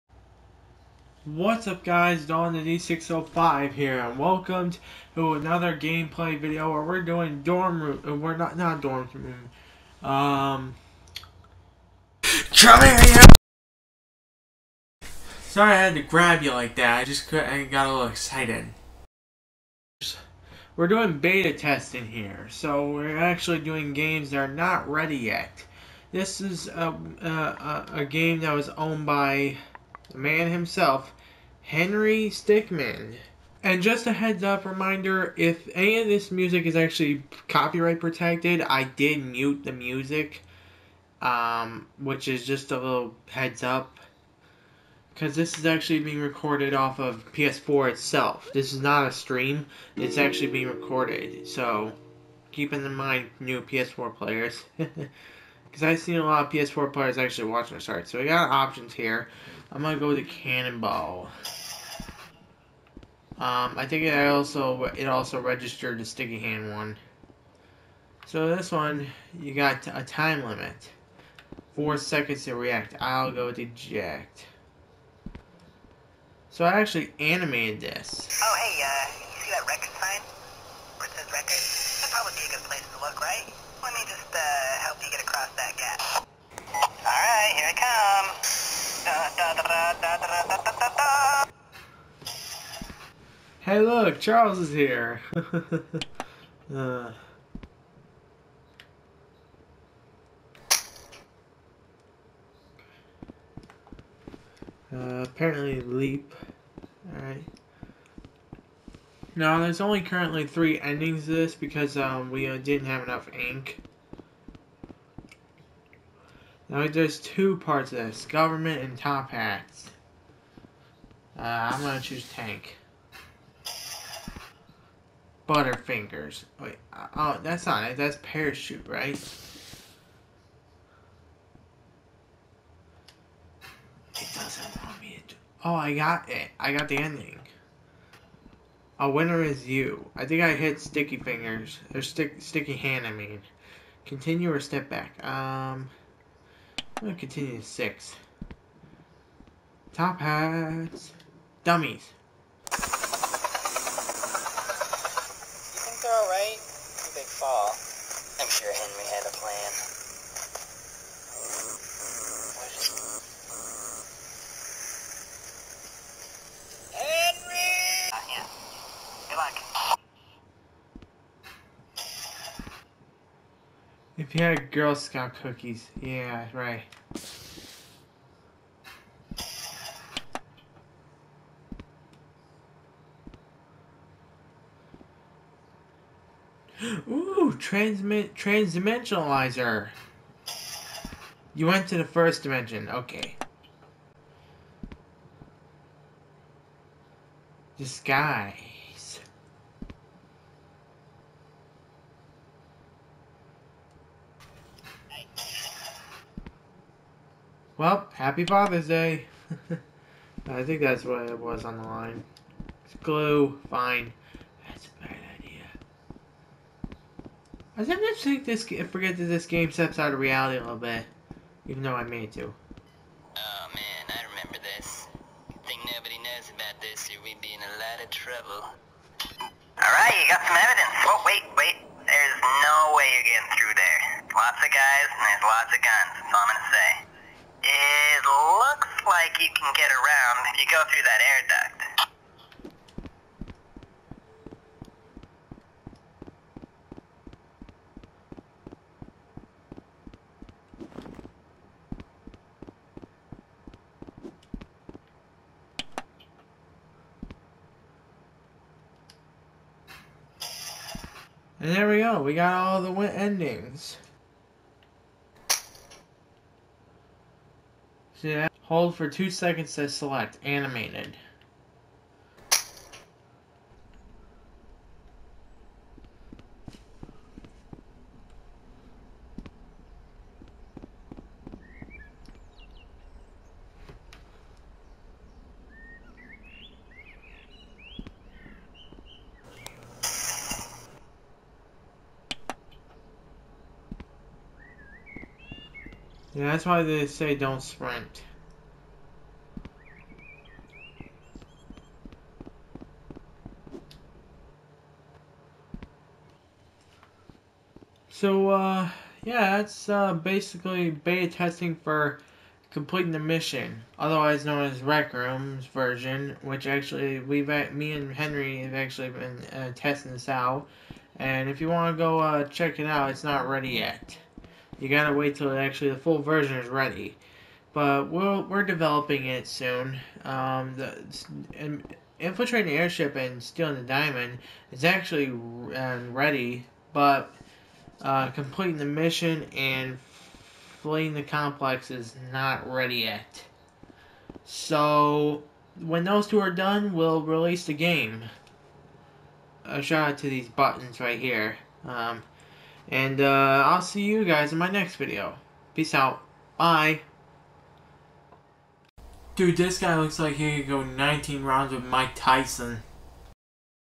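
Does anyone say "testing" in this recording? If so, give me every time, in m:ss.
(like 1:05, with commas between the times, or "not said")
0:21, 5:11, 5:19.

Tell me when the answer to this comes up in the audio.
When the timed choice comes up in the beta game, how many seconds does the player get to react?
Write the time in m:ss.
1:11.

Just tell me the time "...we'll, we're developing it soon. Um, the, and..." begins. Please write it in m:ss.
5:28.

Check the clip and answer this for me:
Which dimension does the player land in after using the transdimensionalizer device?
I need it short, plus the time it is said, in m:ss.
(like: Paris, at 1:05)
first dimension, at 3:12.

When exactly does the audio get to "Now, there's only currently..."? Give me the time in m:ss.
1:49.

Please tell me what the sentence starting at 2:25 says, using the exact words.
Um, I'm going to continue to six.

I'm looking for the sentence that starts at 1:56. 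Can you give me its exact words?
Now, there's two parts of this.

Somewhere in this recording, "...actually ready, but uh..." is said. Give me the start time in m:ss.
5:34.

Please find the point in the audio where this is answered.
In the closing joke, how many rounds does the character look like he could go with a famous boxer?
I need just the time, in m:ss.
6:00.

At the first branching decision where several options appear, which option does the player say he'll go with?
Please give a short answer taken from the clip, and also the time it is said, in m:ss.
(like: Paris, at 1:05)
cannonball, at 1:00.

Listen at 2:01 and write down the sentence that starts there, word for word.
Uh, I'm going to choose Tank.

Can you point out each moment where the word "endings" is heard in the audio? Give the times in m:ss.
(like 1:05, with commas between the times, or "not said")
1:50, 2:16, 4:23.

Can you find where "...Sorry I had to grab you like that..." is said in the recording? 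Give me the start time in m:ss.
0:15.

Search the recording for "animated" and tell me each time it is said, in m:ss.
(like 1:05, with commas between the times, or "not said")
1:17, 4:30.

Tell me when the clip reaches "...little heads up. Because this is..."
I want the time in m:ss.
0:42.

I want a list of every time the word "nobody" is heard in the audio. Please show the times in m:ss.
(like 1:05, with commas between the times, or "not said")
3:45.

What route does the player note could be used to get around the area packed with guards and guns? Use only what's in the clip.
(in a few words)
air duct.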